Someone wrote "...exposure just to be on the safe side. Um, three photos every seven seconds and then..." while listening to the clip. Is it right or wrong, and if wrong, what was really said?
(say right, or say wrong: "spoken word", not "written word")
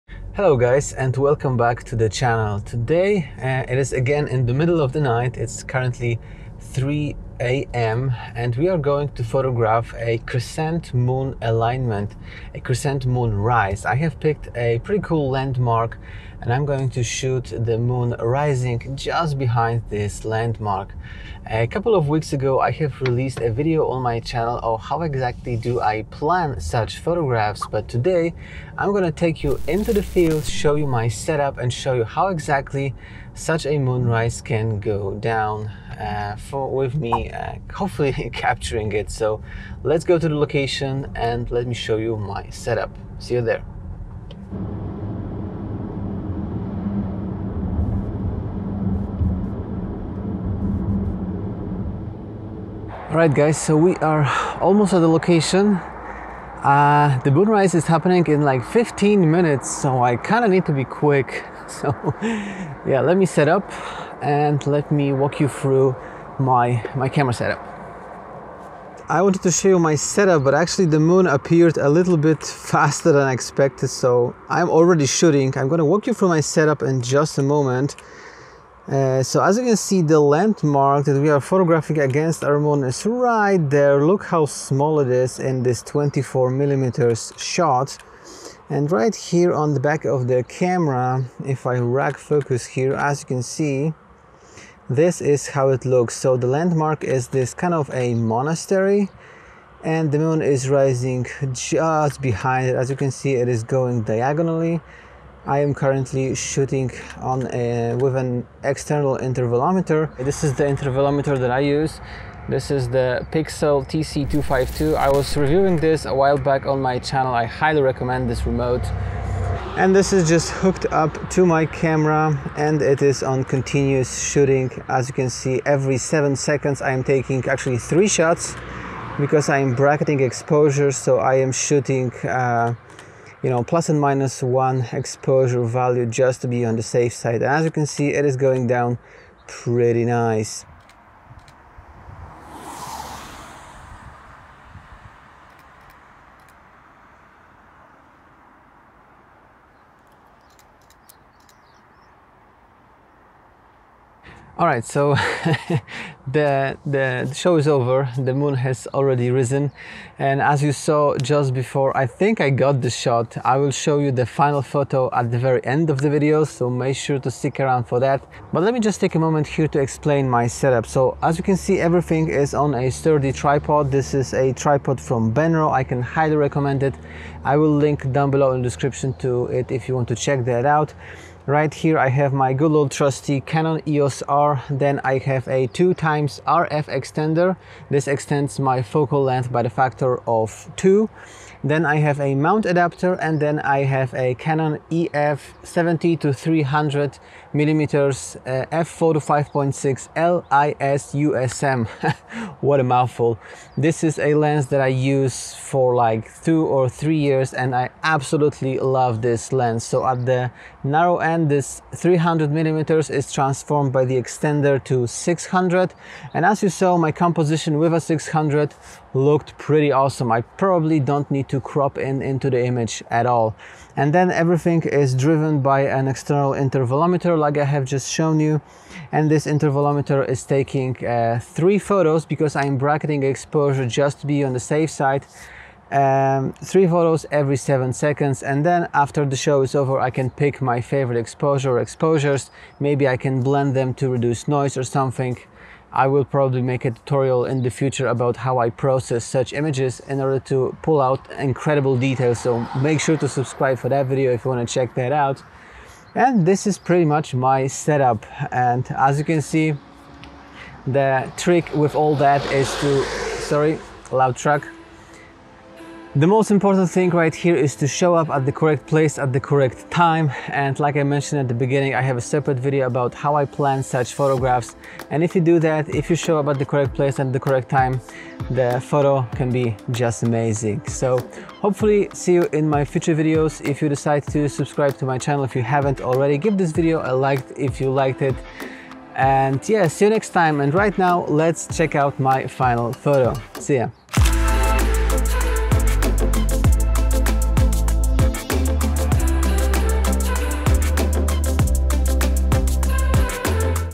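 right.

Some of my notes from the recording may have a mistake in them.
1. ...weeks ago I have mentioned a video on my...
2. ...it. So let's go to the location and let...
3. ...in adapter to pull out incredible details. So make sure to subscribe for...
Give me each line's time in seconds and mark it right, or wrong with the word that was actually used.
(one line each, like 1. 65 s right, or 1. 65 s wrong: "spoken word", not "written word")
1. 22 s wrong: "released", not "mentioned"
2. 38 s right
3. 250 s wrong: "order", not "adapter".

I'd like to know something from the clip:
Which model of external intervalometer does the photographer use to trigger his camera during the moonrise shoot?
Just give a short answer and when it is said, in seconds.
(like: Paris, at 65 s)
Pixel TC252, at 113 s.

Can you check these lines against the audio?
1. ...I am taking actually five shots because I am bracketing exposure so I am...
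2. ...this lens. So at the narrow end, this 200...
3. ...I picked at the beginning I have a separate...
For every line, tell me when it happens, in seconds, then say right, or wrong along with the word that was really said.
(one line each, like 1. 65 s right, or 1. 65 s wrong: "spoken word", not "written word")
1. 126 s wrong: "three", not "five"
2. 209 s wrong: "300", not "200"
3. 270 s wrong: "mentioned", not "picked".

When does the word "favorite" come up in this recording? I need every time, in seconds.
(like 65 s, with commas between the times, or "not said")
240 s.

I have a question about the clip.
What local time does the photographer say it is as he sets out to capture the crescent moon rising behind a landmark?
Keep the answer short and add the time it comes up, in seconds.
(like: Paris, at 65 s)
3 a.m., at 6 s.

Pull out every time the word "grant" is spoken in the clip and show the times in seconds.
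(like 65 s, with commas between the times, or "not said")
not said.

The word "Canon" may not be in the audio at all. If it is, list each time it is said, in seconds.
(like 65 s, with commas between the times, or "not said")
183 s, 194 s.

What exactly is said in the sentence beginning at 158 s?
The moon has already risen, and as you saw just before, I think I got the shot.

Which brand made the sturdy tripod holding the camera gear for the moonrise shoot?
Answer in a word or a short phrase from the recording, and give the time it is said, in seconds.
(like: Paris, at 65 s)
Benro, at 175 s.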